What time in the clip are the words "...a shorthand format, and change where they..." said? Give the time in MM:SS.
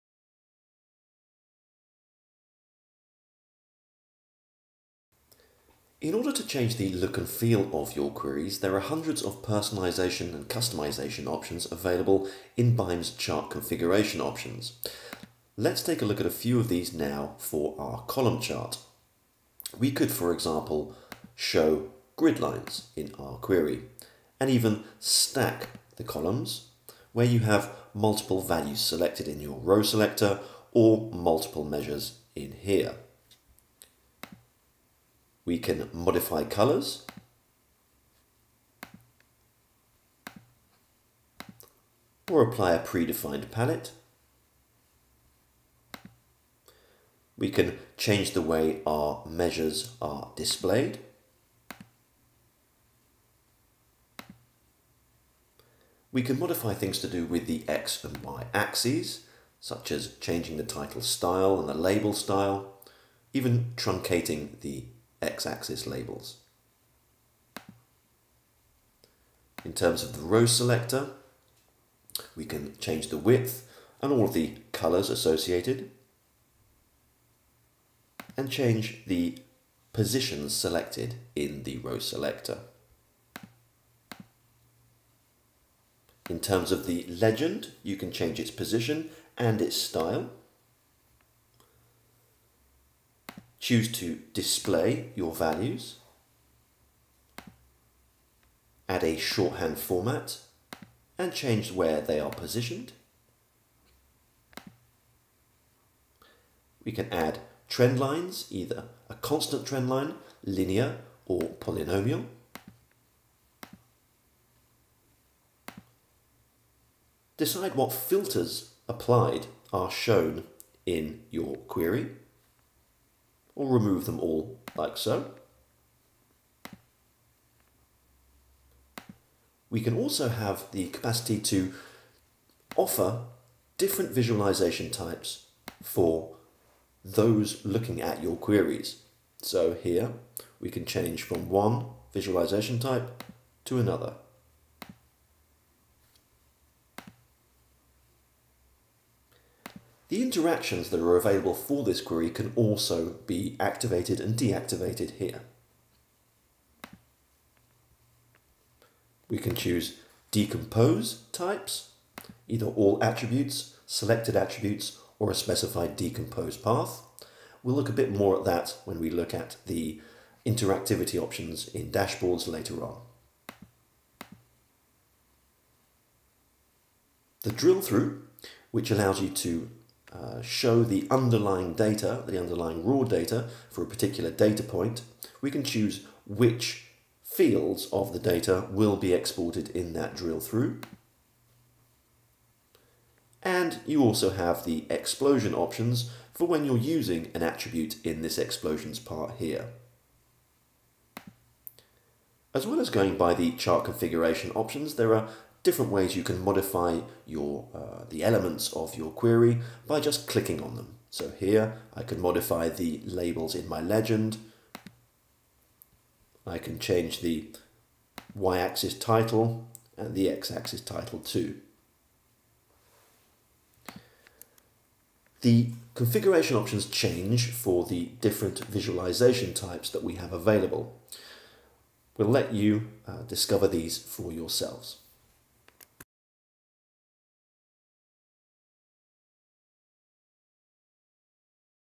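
01:39.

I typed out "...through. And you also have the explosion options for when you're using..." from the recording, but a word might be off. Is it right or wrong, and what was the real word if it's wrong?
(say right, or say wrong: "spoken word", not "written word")
right.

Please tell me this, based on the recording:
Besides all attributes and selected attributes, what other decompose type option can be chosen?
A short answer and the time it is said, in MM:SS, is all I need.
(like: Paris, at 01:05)
Specified decompose path, at 02:45.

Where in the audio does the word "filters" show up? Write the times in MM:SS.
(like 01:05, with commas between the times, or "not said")
01:57.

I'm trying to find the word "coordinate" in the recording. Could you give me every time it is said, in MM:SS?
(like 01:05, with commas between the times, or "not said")
not said.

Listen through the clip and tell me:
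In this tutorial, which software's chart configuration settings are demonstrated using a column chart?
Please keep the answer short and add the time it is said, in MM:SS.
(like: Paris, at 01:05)
BIME, at 00:12.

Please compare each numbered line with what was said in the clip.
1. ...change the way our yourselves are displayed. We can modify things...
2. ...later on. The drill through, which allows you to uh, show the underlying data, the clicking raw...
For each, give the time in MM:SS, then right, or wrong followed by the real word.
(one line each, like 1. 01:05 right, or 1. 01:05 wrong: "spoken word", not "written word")
1. 00:47 wrong: "measures", not "yourselves"
2. 02:52 wrong: "underlying", not "clicking".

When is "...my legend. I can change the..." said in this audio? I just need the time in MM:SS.
03:33.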